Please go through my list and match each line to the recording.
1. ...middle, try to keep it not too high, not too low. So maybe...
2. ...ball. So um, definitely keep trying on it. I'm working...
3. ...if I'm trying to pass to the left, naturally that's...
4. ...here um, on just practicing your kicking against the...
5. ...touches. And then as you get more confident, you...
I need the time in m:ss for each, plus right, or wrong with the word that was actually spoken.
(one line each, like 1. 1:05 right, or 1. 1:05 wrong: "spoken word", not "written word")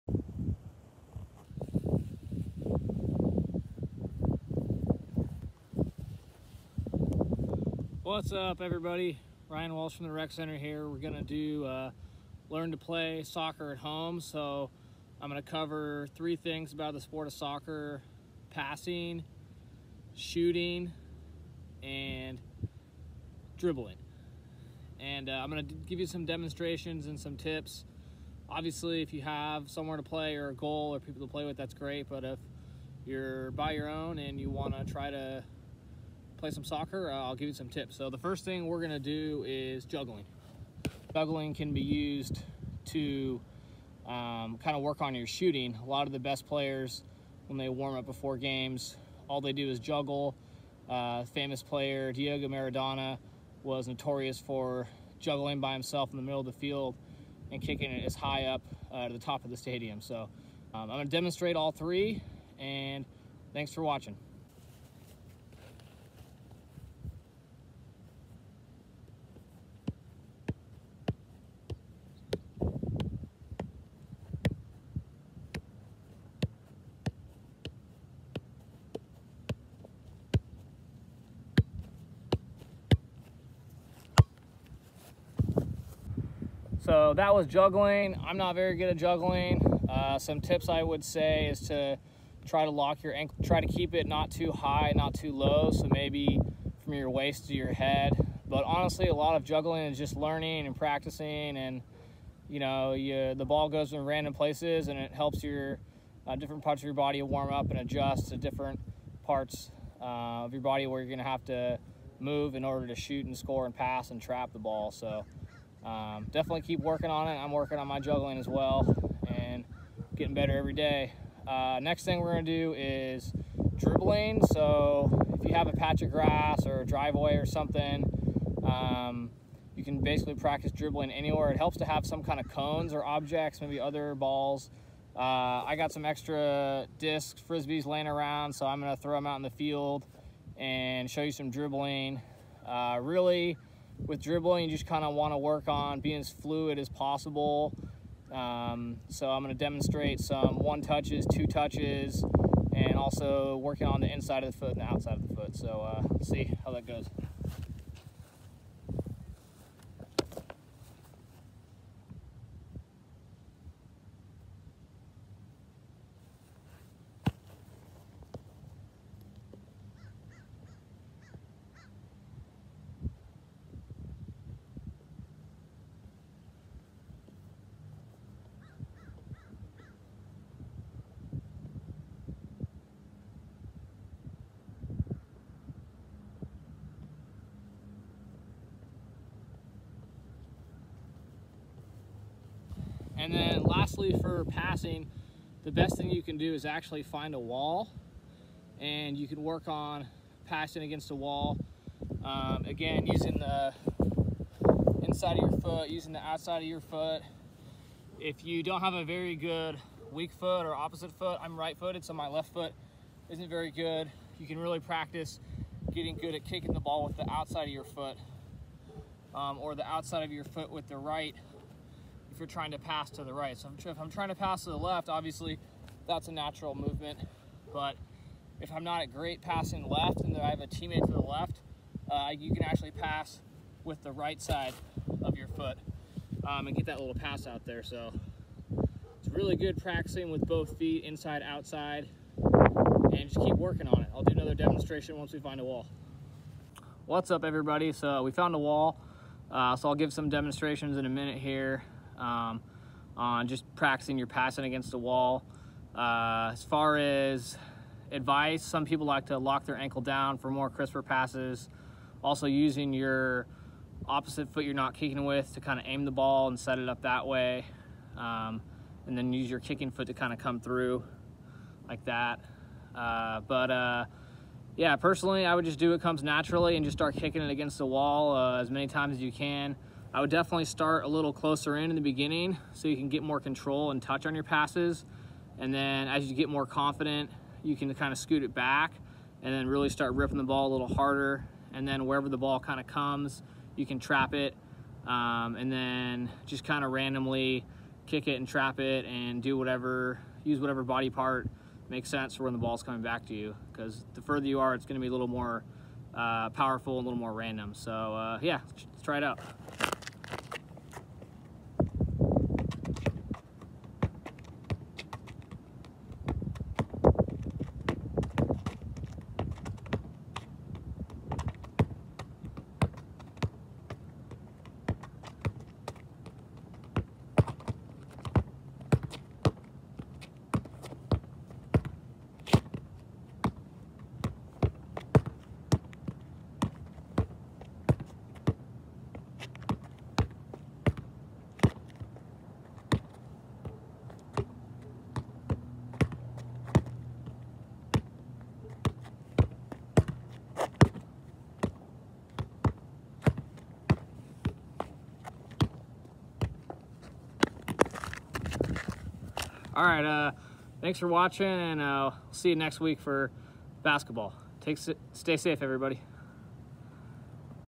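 1. 1:33 wrong: "ankle", not "middle"
2. 1:54 wrong: "working", not "trying"
3. 3:43 wrong: "obviously", not "naturally"
4. 4:11 wrong: "passing", not "kicking"
5. 4:44 wrong: "passes", not "touches".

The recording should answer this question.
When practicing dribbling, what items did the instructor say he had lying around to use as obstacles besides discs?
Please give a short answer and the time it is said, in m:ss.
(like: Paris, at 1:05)
frisbees, at 2:17.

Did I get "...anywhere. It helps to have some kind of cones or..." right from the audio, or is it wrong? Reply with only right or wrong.
right.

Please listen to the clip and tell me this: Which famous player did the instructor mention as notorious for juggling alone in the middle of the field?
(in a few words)
Diego Maradona.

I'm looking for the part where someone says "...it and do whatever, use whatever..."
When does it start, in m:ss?
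4:58.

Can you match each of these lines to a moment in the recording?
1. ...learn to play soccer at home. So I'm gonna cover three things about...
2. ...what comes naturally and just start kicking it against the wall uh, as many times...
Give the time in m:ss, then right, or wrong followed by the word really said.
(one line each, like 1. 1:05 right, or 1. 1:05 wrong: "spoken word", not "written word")
1. 0:12 right
2. 4:35 right.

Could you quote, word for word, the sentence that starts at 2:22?
Uh, really, with dribbling, you just kind of want to work on being as fluid as possible.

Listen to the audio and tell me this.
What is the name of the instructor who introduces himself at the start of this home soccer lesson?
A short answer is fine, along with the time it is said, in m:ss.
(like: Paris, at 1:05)
Ryan Walsh, at 0:09.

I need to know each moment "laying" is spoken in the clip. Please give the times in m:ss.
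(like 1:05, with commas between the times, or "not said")
2:17.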